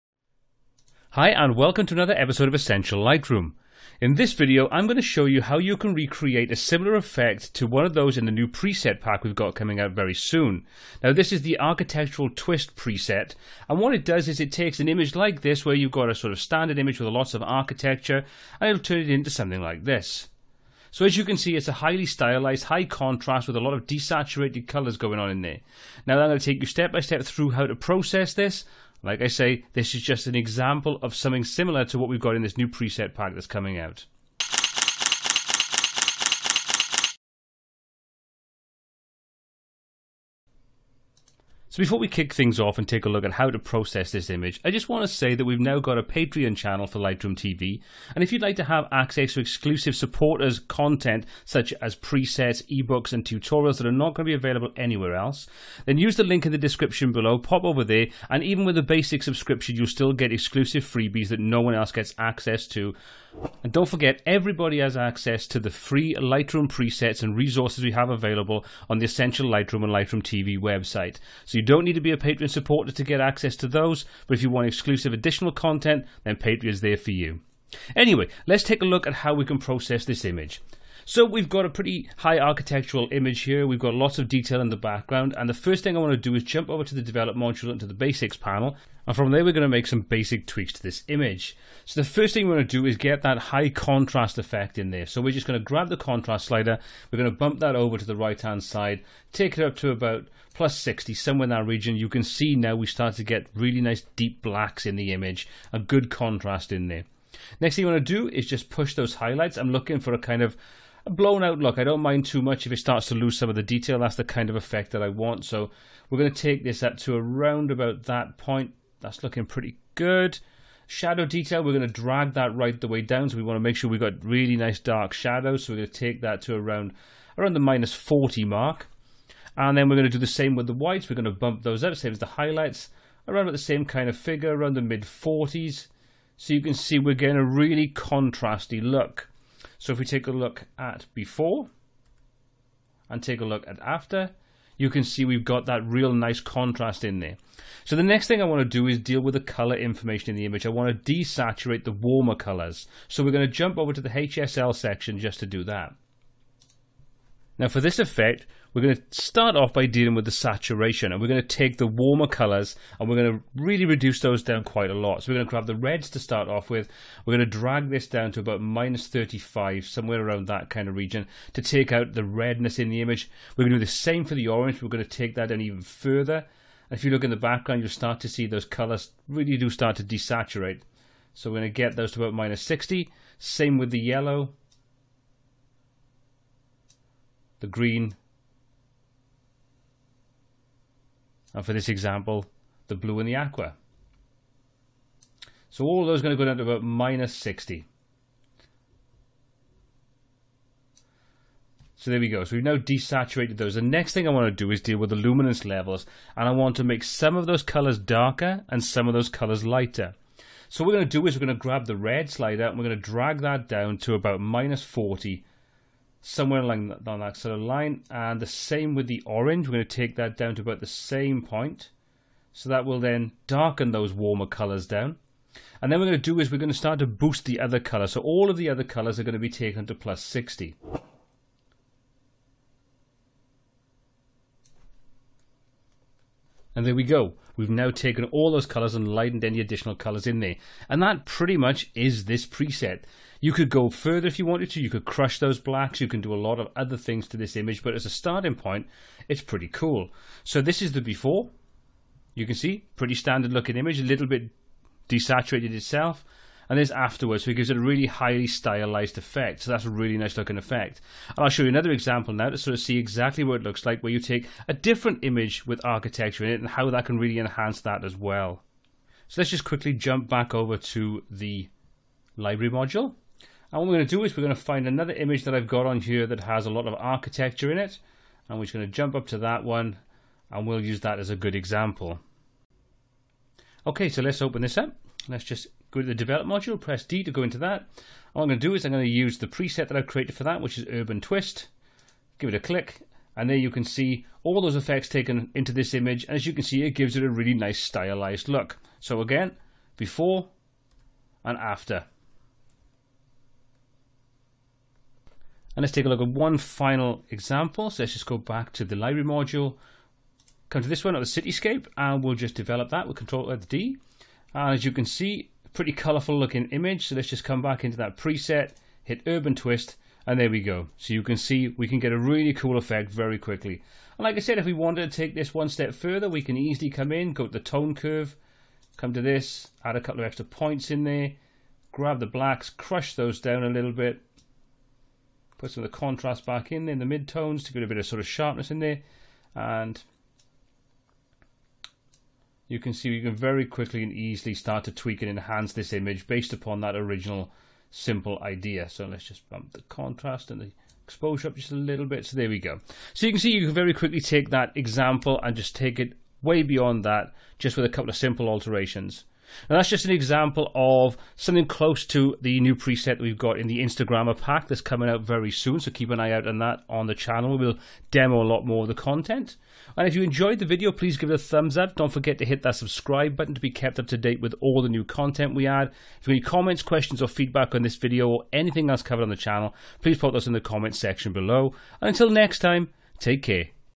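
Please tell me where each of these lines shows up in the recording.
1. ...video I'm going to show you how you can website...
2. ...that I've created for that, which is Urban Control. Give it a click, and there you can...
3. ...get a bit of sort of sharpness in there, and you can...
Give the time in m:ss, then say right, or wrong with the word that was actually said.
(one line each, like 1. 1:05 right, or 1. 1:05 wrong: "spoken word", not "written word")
1. 0:04 wrong: "recreate", not "website"
2. 4:49 wrong: "Twist", not "Control"
3. 5:37 right.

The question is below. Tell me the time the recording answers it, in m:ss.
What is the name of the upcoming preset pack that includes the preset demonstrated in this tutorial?
6:03.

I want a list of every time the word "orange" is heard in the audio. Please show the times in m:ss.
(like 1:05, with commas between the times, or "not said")
2:54, 3:39.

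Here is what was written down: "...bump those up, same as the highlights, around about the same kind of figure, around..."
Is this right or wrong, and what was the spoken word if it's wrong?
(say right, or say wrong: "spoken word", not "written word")
right.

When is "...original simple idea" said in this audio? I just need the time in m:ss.
5:46.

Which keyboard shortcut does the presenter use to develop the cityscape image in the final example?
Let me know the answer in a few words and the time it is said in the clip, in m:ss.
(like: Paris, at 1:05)
Control D, at 5:13.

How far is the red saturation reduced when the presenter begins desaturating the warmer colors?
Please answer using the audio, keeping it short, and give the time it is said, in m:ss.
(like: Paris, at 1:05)
-35, at 2:48.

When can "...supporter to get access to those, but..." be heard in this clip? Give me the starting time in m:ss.
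1:12.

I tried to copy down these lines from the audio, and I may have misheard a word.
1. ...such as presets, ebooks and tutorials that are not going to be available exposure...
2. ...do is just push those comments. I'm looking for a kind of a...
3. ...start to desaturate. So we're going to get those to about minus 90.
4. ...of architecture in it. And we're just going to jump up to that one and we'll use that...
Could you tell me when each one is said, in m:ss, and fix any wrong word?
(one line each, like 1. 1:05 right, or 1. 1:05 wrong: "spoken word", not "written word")
1. 0:51 wrong: "anywhere", not "exposure"
2. 1:48 wrong: "highlights", not "comments"
3. 2:59 wrong: "60", not "90"
4. 4:36 right.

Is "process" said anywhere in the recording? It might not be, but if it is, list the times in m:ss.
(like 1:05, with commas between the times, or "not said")
0:27, 0:43, 1:19.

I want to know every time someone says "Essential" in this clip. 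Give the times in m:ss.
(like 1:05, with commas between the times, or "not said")
0:02, 1:09.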